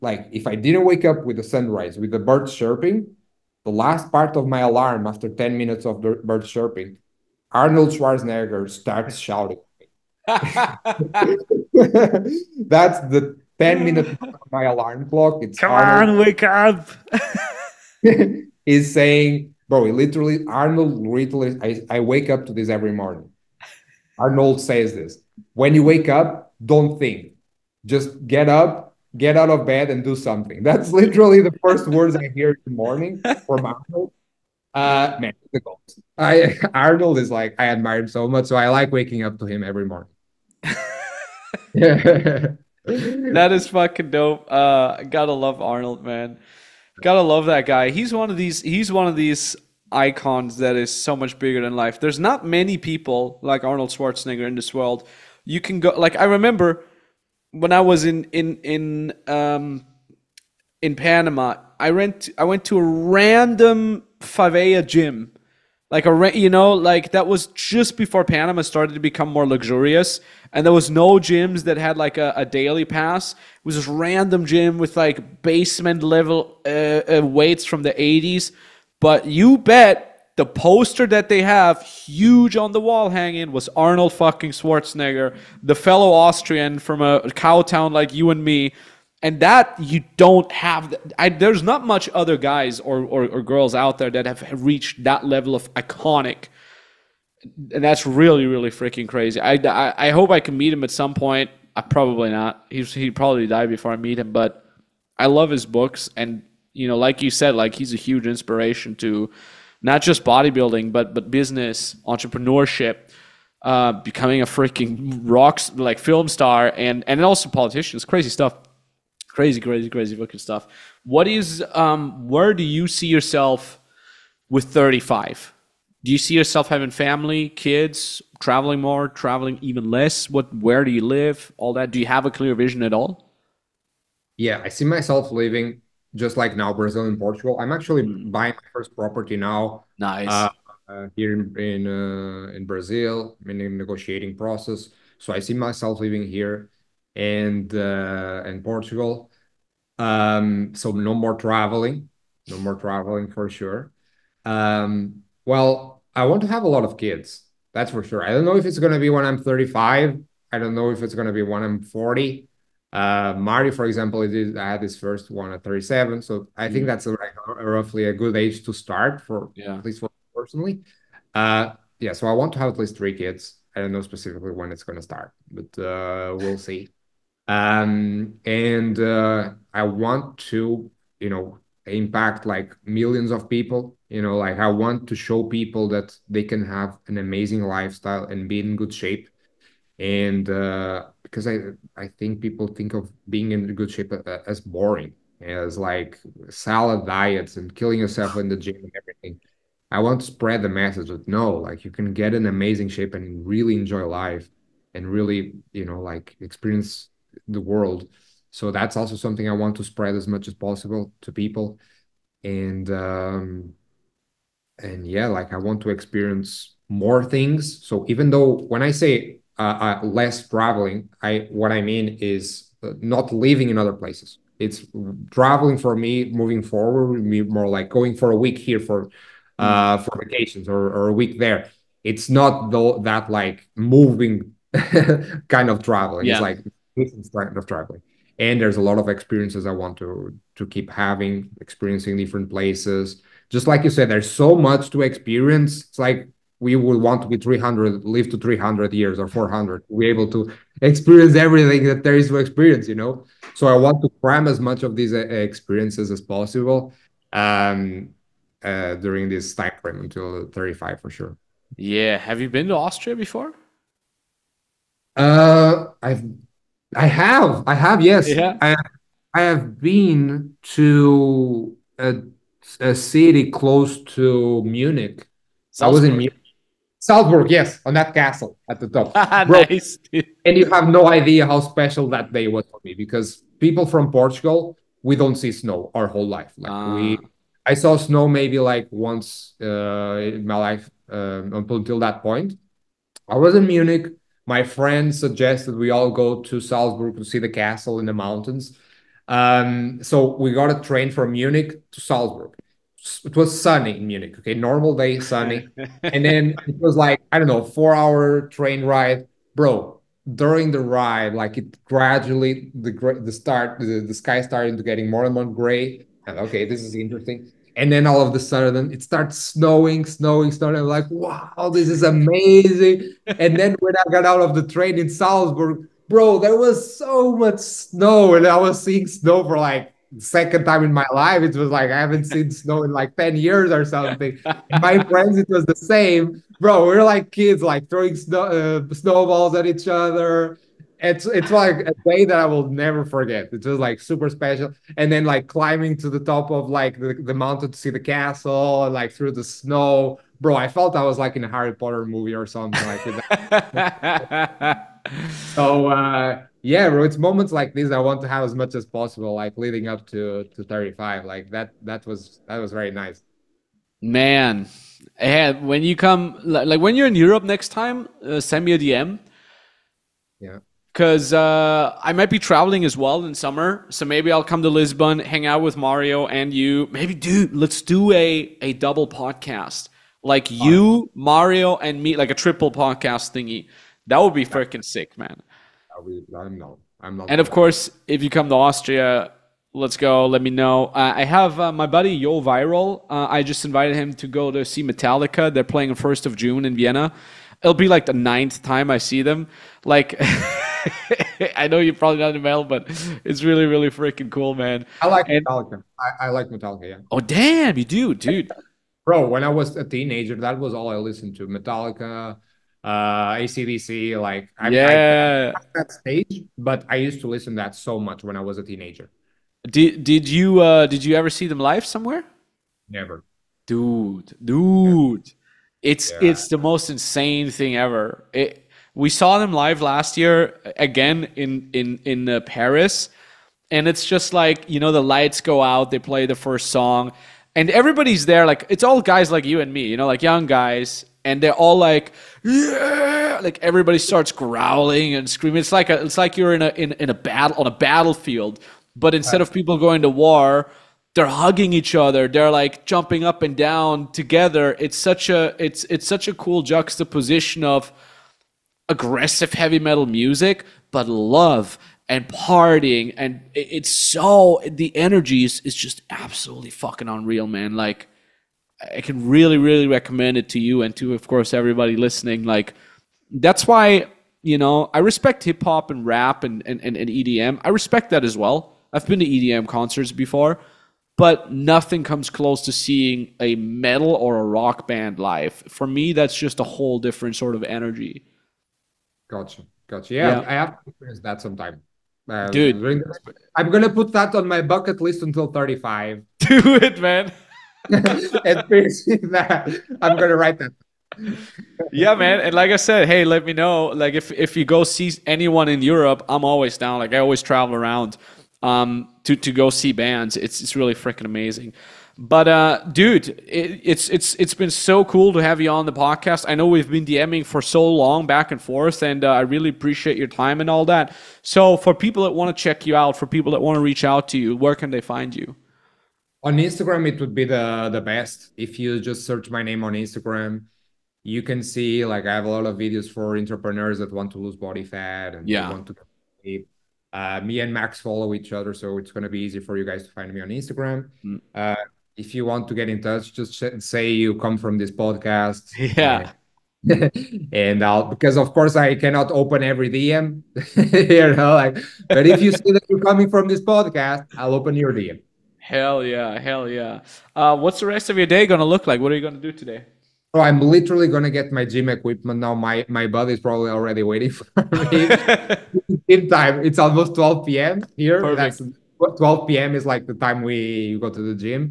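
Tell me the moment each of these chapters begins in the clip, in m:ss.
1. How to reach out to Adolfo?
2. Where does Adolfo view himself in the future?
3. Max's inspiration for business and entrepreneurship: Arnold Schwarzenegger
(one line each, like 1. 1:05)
1. 8:40
2. 2:00
3. 0:45.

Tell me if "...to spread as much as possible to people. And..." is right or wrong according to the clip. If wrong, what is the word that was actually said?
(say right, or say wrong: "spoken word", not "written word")
right.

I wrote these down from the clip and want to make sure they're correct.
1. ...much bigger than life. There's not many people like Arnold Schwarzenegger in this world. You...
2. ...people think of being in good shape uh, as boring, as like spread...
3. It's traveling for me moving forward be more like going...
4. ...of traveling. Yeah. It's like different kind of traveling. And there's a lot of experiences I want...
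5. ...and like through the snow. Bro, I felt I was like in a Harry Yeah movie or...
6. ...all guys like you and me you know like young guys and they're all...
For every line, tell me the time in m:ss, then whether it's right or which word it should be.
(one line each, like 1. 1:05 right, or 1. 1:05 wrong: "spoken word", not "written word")
1. 0:51 right
2. 3:12 wrong: "salad", not "spread"
3. 3:44 right
4. 3:55 right
5. 5:48 wrong: "Potter", not "Yeah"
6. 7:18 right.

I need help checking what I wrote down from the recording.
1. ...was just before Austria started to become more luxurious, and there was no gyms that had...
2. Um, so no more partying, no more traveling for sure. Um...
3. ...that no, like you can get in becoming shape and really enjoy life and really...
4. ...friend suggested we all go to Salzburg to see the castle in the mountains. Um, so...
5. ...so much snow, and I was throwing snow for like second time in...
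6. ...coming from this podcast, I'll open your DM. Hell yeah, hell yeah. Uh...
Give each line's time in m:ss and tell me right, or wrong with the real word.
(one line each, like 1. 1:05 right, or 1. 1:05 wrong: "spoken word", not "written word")
1. 1:07 wrong: "Panama", not "Austria"
2. 2:29 wrong: "traveling", not "partying"
3. 3:21 wrong: "amazing", not "becoming"
4. 4:54 right
5. 5:26 wrong: "seeing", not "throwing"
6. 9:13 right.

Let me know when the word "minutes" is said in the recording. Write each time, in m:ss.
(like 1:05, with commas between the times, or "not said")
0:05, 0:13.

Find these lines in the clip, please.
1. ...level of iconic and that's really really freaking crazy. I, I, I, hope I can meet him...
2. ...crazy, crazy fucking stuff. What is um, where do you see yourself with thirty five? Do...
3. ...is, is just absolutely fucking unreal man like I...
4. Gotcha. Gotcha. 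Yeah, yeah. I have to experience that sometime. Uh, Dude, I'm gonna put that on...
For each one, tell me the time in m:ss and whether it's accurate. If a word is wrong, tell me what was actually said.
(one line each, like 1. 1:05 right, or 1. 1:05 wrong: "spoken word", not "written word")
1. 1:35 right
2. 1:59 right
3. 7:45 right
4. 8:09 right.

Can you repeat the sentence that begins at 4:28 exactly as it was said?
i i have been to a, a city close to munich Salzburg.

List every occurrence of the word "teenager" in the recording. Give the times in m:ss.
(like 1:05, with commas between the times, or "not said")
6:49, 6:58.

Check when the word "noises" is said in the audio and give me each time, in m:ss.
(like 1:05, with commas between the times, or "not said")
not said.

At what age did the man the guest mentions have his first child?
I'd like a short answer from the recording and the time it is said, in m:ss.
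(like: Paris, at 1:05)
37, at 2:45.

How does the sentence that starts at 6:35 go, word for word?
They're playing the first of June in Vienna.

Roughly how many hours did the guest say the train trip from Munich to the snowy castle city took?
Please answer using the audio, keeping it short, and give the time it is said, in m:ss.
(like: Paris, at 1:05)
4, at 5:07.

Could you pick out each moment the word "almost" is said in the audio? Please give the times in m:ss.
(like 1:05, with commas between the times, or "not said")
9:26.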